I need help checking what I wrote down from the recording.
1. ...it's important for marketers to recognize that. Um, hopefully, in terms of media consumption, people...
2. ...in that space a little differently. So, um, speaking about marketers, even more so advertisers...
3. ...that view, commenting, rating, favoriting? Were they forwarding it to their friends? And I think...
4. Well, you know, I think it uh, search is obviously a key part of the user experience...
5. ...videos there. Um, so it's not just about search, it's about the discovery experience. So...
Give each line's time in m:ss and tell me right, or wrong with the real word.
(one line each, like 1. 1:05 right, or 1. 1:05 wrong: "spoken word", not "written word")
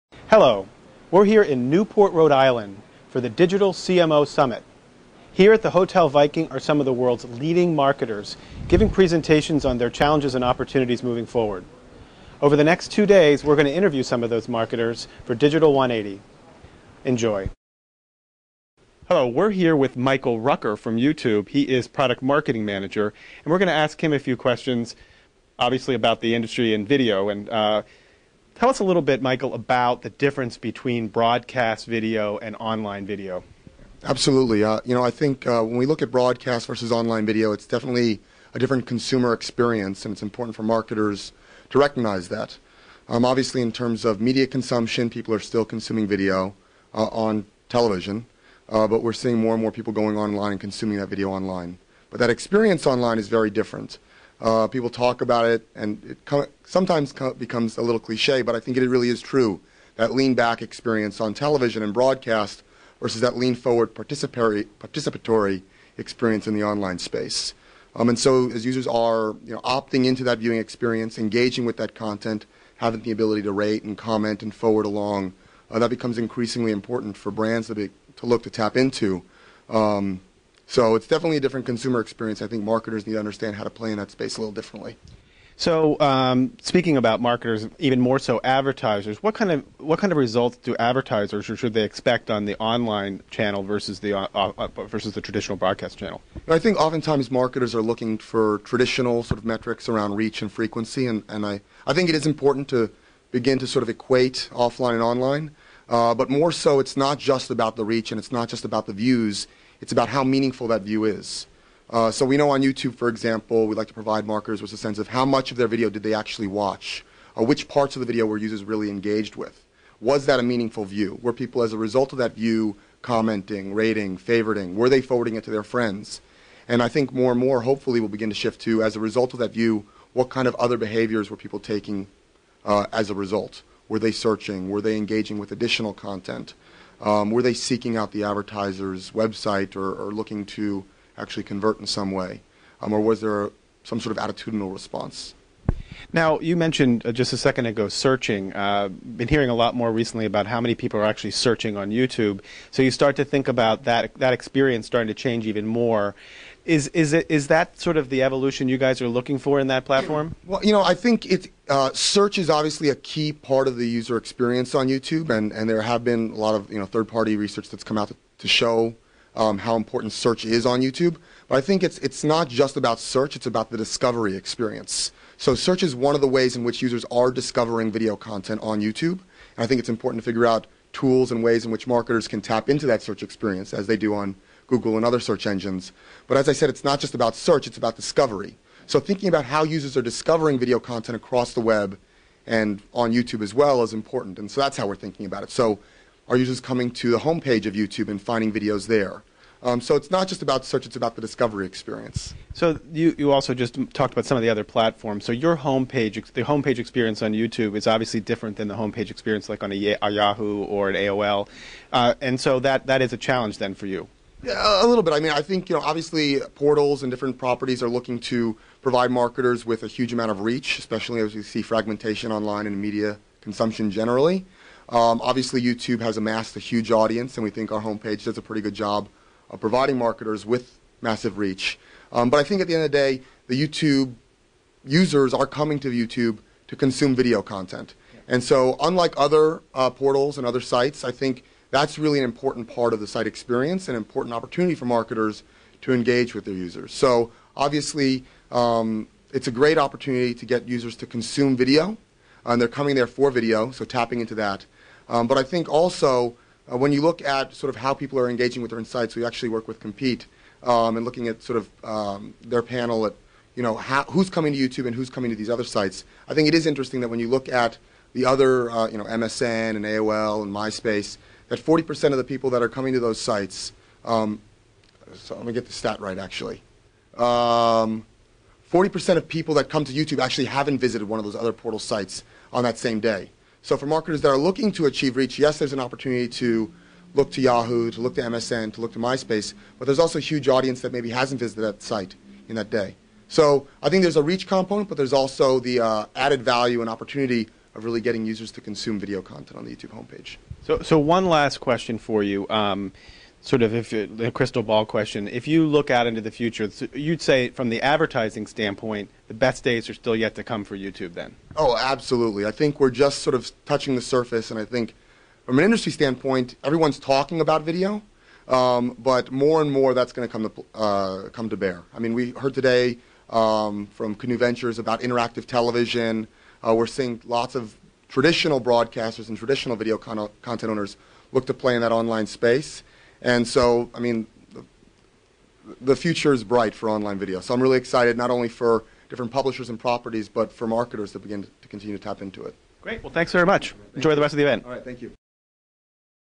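1. 0:40 wrong: "obviously", not "hopefully"
2. 1:23 right
3. 2:02 right
4. 2:40 right
5. 3:18 right.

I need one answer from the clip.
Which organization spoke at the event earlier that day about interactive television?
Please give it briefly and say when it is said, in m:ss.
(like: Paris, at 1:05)
Canoe Ventures, at 5:24.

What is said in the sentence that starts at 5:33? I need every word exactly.
And so, I mean, the, the future is bright for online video.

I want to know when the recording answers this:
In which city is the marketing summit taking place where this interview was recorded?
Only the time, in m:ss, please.
0:01.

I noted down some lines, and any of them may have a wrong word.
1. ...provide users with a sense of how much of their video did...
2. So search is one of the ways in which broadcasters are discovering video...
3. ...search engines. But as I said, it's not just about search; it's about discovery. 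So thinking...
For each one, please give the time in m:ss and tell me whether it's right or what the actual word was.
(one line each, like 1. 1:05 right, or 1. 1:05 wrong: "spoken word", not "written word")
1. 1:53 wrong: "markers", not "users"
2. 2:55 wrong: "users", not "broadcasters"
3. 3:05 right.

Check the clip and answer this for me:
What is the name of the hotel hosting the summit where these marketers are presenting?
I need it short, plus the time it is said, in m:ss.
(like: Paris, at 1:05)
Hotel Viking, at 0:05.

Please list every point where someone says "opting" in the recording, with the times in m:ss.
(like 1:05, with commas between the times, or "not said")
1:09.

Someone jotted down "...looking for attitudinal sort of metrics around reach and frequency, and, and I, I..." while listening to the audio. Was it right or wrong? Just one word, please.
wrong.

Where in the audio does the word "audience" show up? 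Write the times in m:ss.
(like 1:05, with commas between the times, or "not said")
3:46, 4:50.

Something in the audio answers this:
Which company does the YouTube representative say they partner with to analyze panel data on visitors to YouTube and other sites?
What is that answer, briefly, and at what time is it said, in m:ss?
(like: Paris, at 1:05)
Compete, at 4:19.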